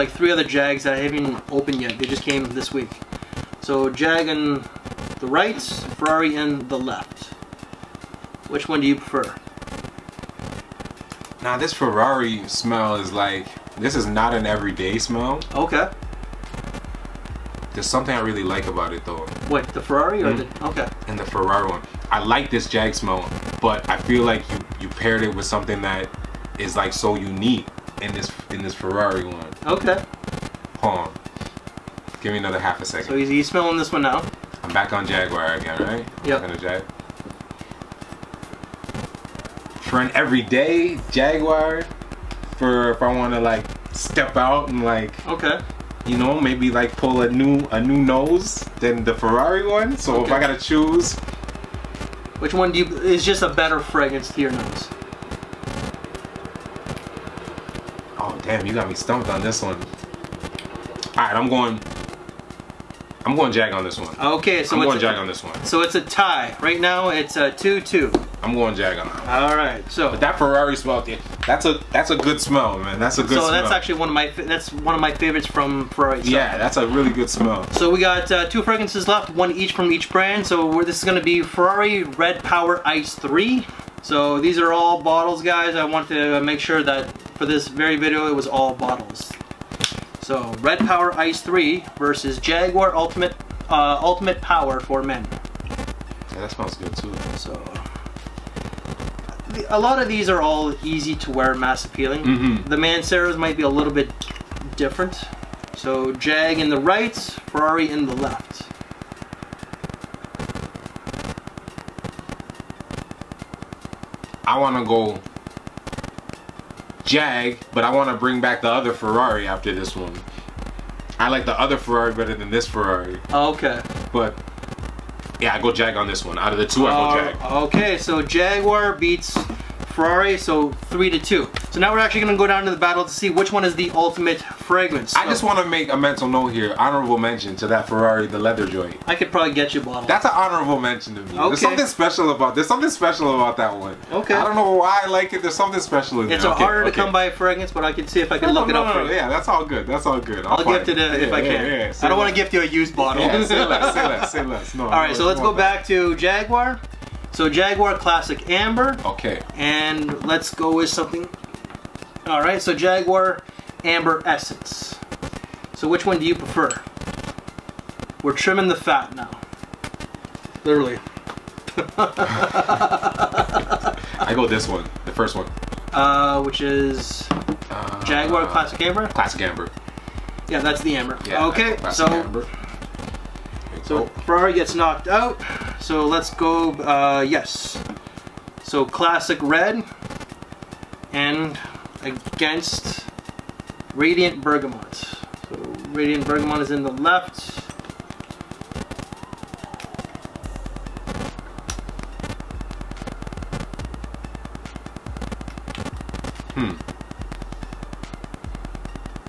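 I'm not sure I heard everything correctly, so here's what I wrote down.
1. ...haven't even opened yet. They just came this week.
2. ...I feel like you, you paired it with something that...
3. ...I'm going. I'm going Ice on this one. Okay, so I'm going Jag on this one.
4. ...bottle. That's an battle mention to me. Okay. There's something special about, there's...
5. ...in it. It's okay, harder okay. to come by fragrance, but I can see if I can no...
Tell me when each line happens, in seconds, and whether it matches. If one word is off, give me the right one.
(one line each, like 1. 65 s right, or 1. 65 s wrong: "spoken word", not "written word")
1. 0 s right
2. 23 s right
3. 61 s wrong: "Jag", not "Ice"
4. 139 s wrong: "honorable", not "battle"
5. 146 s right.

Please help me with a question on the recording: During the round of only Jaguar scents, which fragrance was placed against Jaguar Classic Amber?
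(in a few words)
Jaguar Amber Essence.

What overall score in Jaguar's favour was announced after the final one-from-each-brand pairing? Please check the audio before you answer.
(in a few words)
3 to 2.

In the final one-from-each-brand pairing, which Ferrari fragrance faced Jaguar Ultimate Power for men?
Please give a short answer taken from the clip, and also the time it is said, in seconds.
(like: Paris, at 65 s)
Red Power Ice 3, at 81 s.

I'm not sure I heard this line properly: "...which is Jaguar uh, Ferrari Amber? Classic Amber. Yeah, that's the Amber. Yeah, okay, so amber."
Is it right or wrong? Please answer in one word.
wrong.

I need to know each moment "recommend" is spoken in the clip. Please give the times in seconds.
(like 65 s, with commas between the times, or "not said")
not said.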